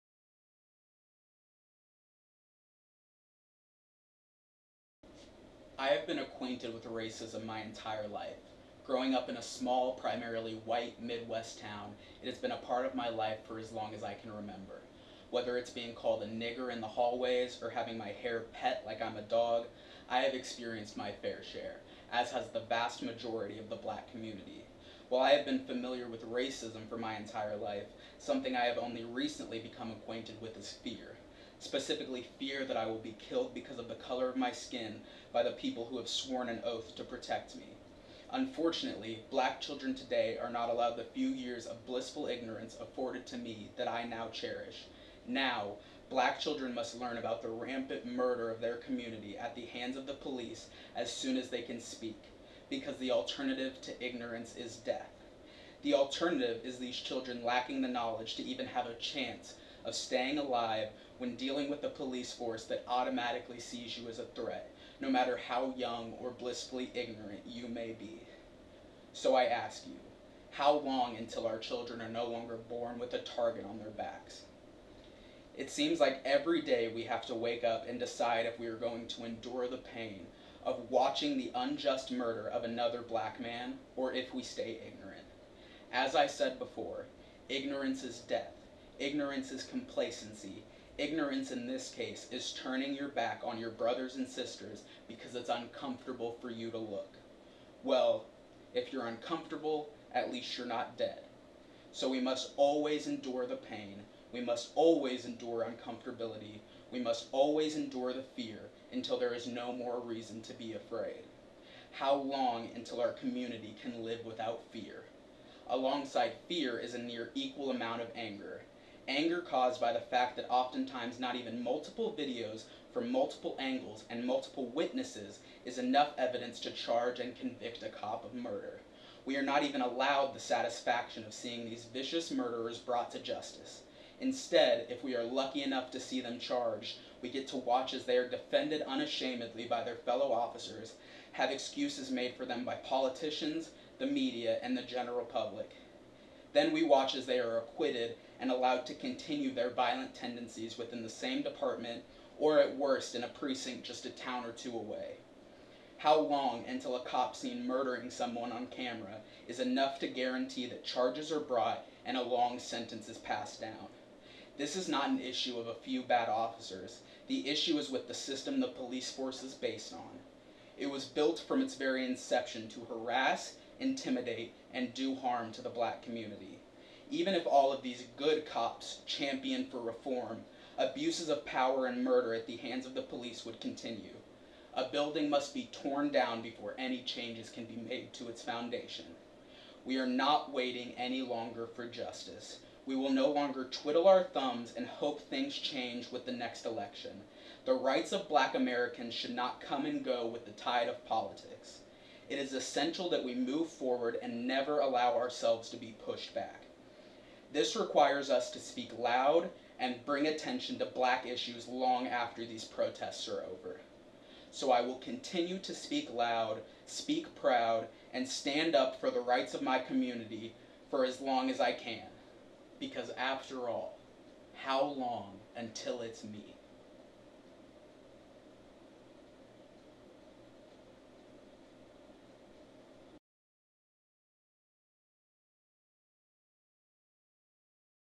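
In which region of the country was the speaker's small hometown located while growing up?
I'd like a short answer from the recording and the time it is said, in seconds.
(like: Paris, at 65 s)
Midwest, at 11 s.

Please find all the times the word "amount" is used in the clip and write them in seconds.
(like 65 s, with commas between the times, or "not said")
117 s.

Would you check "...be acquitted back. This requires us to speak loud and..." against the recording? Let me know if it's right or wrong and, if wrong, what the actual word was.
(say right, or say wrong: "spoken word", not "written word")
wrong: "pushed", not "acquitted".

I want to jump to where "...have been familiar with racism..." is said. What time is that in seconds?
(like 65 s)
25 s.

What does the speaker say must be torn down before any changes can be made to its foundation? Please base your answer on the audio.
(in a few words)
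a building.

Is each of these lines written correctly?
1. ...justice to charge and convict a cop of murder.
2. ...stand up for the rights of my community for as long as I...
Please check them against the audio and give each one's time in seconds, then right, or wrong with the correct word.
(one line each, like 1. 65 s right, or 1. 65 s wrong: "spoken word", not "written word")
1. 126 s wrong: "evidence", not "justice"
2. 218 s right.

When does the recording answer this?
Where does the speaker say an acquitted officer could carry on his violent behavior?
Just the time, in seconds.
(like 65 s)
153 s.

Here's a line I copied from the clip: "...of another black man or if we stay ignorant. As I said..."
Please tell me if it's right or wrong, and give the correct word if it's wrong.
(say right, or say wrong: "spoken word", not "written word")
right.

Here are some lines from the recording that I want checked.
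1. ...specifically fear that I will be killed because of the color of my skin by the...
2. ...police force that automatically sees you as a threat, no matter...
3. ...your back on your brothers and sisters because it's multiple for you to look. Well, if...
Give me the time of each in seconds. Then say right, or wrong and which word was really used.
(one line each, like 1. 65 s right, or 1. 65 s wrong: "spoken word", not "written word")
1. 31 s right
2. 61 s right
3. 92 s wrong: "uncomfortable", not "multiple".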